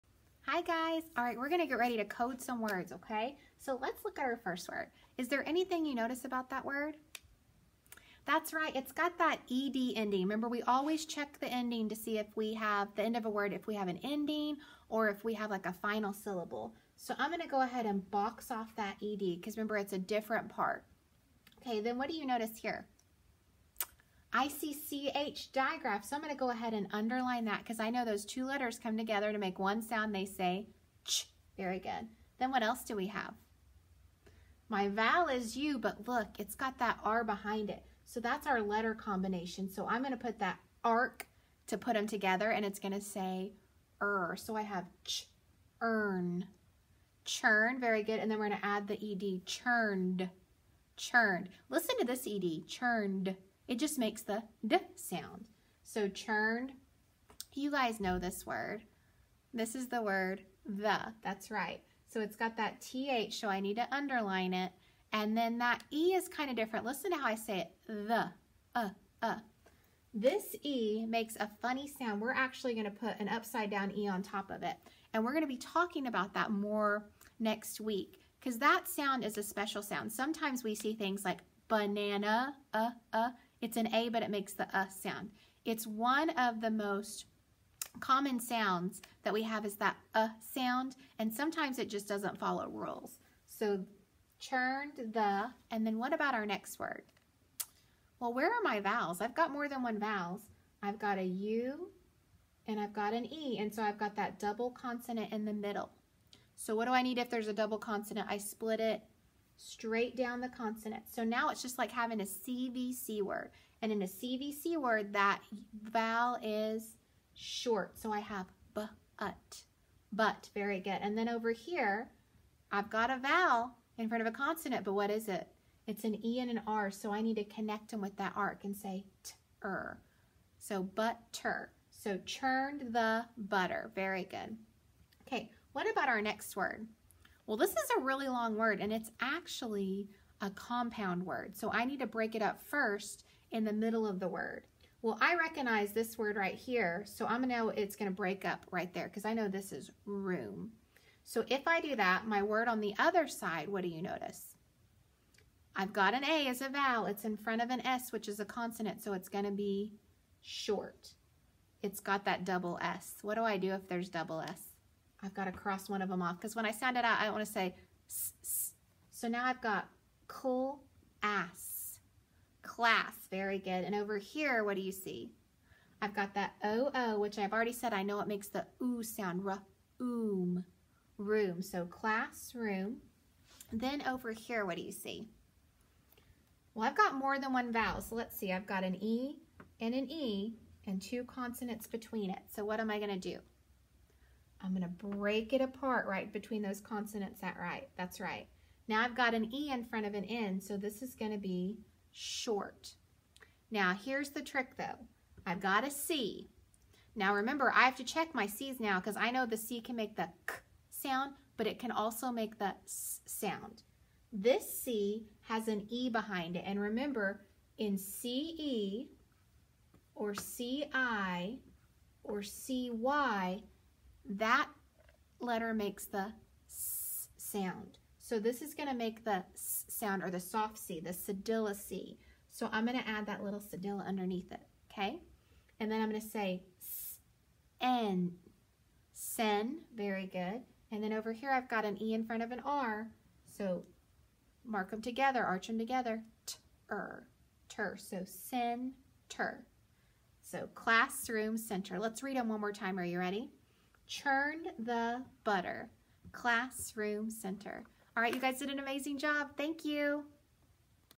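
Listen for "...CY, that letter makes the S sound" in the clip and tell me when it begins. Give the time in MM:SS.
03:42.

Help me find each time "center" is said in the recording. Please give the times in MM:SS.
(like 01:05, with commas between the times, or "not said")
04:11, 04:17.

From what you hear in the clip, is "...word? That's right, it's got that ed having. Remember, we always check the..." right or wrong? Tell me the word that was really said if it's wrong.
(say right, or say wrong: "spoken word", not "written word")
wrong: "ending", not "having".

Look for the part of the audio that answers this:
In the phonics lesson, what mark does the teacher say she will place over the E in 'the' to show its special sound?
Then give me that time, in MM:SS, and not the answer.
01:13.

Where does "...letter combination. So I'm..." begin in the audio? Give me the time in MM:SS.
00:38.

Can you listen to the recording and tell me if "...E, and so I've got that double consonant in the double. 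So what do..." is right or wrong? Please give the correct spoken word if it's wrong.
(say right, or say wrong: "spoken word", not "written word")
wrong: "middle", not "double".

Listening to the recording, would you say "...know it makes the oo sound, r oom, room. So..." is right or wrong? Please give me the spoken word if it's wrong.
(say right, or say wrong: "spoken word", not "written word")
right.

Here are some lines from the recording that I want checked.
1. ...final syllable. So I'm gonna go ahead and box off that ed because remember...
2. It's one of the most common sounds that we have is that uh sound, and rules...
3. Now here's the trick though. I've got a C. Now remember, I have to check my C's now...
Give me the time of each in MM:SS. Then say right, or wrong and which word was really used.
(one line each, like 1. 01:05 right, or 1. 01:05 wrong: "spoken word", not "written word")
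1. 00:15 right
2. 01:25 wrong: "sometimes", not "rules"
3. 03:23 right.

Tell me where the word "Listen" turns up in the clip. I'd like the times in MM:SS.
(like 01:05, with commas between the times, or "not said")
00:51, 01:06.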